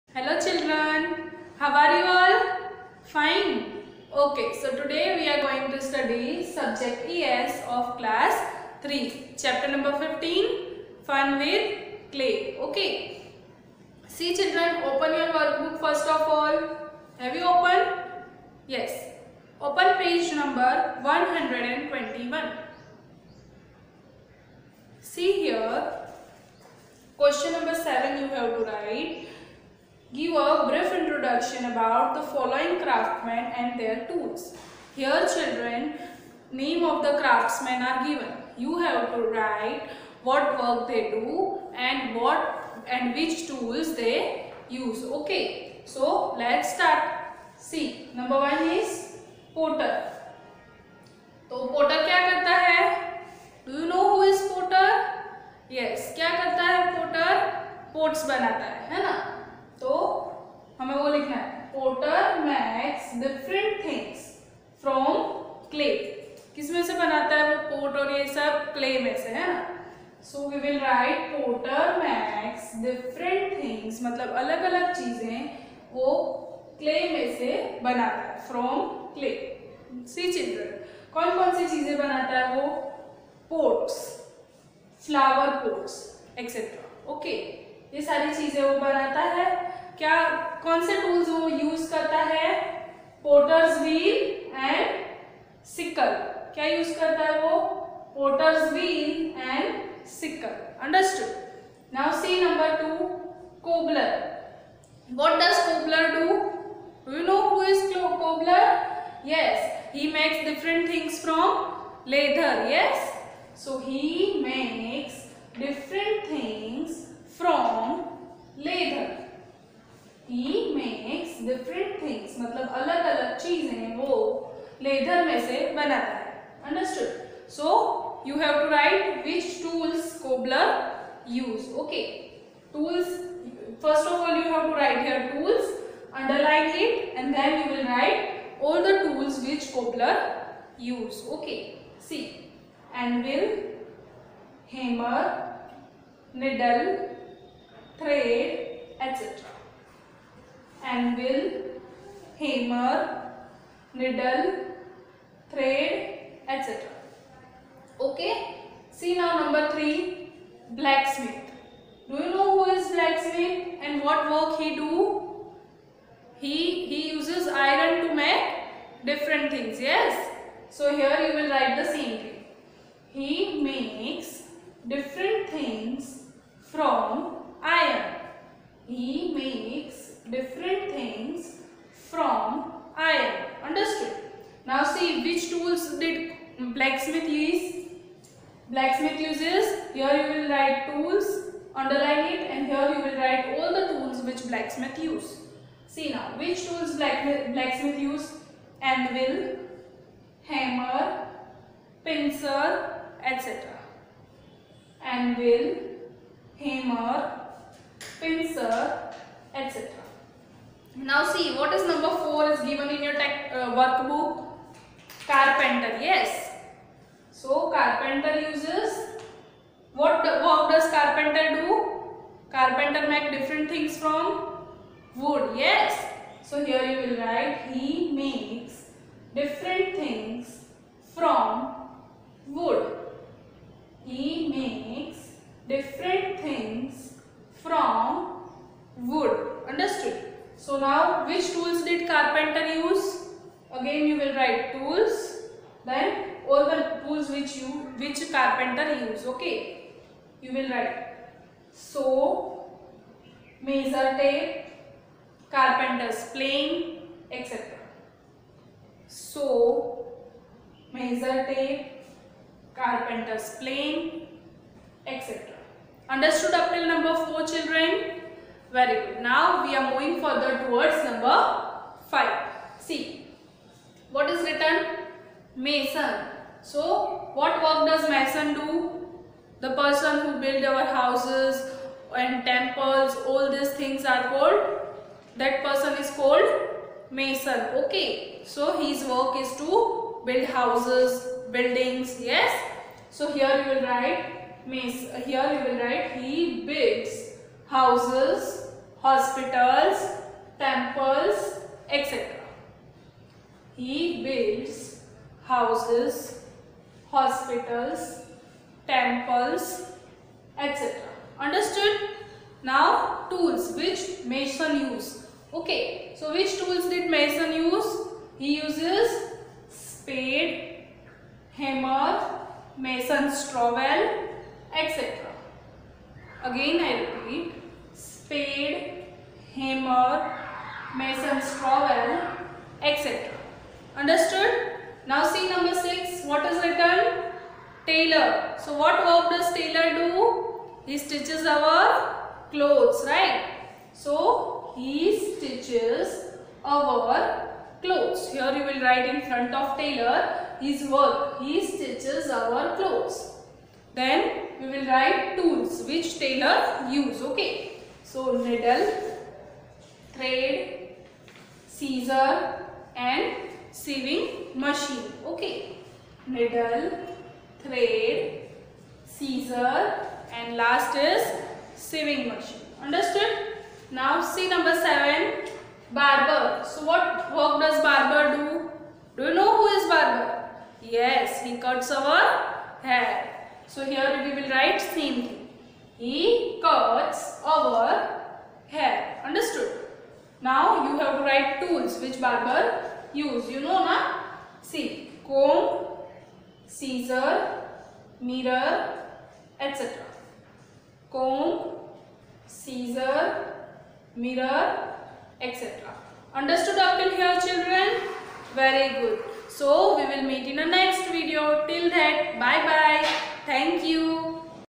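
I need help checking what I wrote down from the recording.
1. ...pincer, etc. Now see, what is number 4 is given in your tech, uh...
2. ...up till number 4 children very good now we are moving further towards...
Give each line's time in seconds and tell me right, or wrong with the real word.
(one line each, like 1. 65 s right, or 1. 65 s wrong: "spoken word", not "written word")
1. 208 s right
2. 266 s right.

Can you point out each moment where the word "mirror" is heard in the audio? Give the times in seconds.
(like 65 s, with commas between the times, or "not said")
398 s, 404 s.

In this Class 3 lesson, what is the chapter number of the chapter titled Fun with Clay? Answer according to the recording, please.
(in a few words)
15.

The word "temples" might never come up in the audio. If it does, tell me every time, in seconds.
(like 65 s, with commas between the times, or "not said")
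282 s, 300 s, 308 s.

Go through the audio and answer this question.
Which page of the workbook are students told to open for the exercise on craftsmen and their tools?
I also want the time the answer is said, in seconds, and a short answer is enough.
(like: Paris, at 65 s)
121, at 21 s.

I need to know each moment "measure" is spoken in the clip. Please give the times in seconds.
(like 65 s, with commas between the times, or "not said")
253 s, 260 s.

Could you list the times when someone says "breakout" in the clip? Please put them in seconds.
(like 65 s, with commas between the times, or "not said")
not said.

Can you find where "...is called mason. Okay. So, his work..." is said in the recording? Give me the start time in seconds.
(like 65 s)
285 s.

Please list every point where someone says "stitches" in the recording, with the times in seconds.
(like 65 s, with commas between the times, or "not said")
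340 s, 345 s, 351 s.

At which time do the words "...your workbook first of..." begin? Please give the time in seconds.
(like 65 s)
15 s.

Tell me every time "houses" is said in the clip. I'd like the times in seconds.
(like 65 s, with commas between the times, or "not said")
280 s, 290 s, 297 s, 305 s.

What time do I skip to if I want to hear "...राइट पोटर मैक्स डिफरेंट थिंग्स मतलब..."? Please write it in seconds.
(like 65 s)
70 s.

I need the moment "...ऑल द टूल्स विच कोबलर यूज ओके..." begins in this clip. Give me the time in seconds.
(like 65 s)
138 s.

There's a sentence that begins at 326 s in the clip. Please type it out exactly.
Again I repeat, spade, hammer, Mason's trowel, etc.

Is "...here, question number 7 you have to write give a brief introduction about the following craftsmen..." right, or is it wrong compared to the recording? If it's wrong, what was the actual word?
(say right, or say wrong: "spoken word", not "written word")
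right.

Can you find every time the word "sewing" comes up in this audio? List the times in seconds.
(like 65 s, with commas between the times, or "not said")
363 s, 371 s.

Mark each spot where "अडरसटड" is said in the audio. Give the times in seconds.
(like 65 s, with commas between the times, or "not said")
100 s, 126 s.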